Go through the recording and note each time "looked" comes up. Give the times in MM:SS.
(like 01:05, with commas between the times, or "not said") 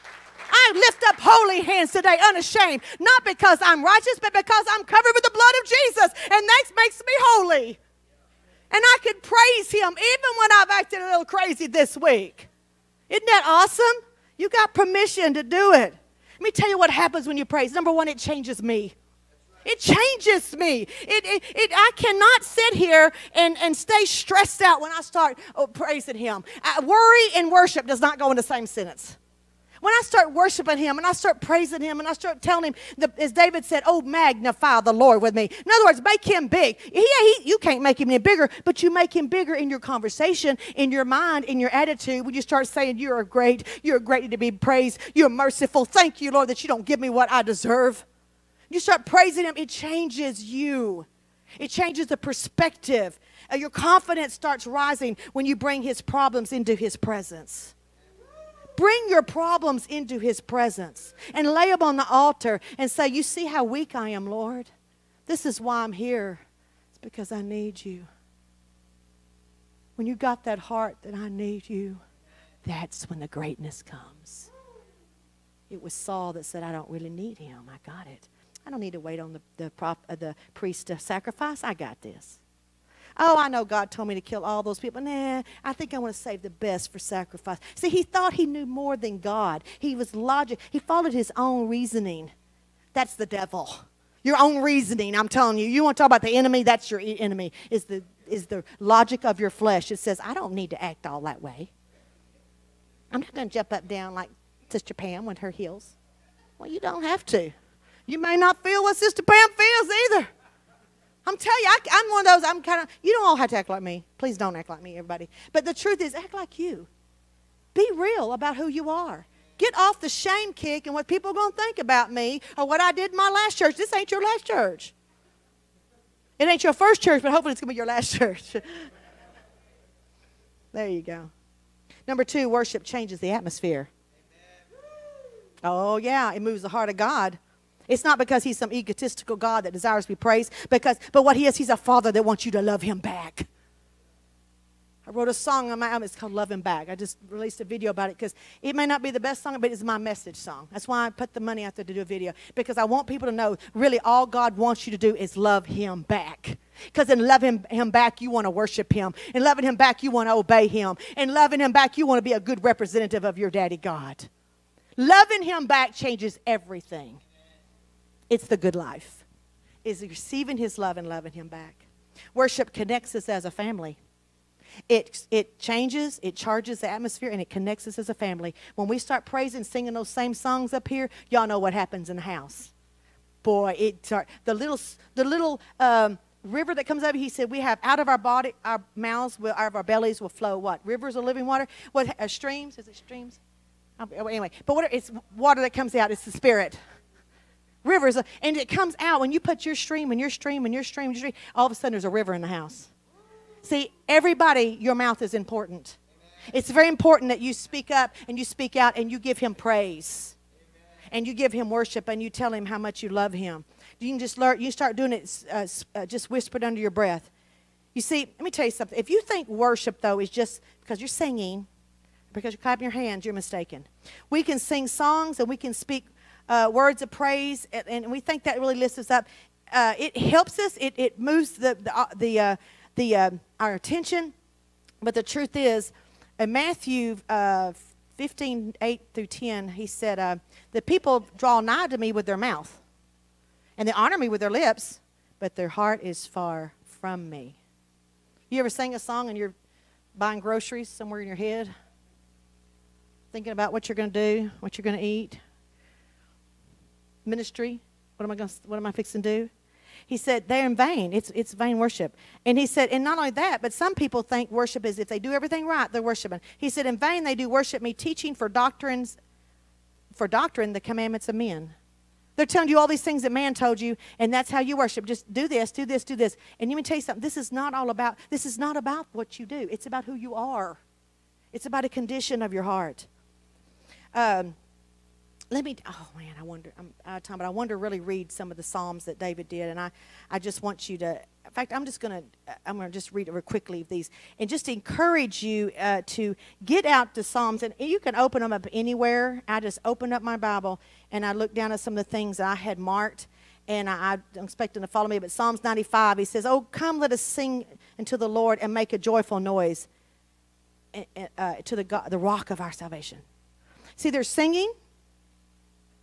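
05:01.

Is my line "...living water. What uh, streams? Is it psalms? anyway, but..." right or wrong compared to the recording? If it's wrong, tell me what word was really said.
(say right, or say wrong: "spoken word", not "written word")
wrong: "streams", not "psalms".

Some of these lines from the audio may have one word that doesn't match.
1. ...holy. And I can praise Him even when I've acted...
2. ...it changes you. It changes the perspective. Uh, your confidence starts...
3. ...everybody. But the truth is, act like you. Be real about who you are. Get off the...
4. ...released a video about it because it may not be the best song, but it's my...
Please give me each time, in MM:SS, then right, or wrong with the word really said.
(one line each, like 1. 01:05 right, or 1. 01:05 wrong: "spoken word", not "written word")
1. 00:07 right
2. 00:49 right
3. 01:54 right
4. 02:27 right.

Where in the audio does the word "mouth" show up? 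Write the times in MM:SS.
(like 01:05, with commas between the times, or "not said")
03:08, 03:24, 04:02.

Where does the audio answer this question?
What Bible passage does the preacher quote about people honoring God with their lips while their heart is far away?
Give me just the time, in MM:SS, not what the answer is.
03:56.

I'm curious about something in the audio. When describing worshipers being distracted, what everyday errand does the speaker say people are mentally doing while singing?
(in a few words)
buying groceries.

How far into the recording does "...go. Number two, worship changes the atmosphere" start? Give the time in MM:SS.
02:11.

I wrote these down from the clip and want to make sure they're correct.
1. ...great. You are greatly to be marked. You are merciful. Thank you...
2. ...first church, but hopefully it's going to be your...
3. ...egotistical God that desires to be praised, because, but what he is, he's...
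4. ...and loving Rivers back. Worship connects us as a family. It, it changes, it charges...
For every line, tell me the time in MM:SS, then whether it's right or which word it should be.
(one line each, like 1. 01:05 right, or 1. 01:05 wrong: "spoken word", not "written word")
1. 00:43 wrong: "praised", not "marked"
2. 02:06 right
3. 02:18 right
4. 02:50 wrong: "Him", not "Rivers".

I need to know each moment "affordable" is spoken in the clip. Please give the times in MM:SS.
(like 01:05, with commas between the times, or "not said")
not said.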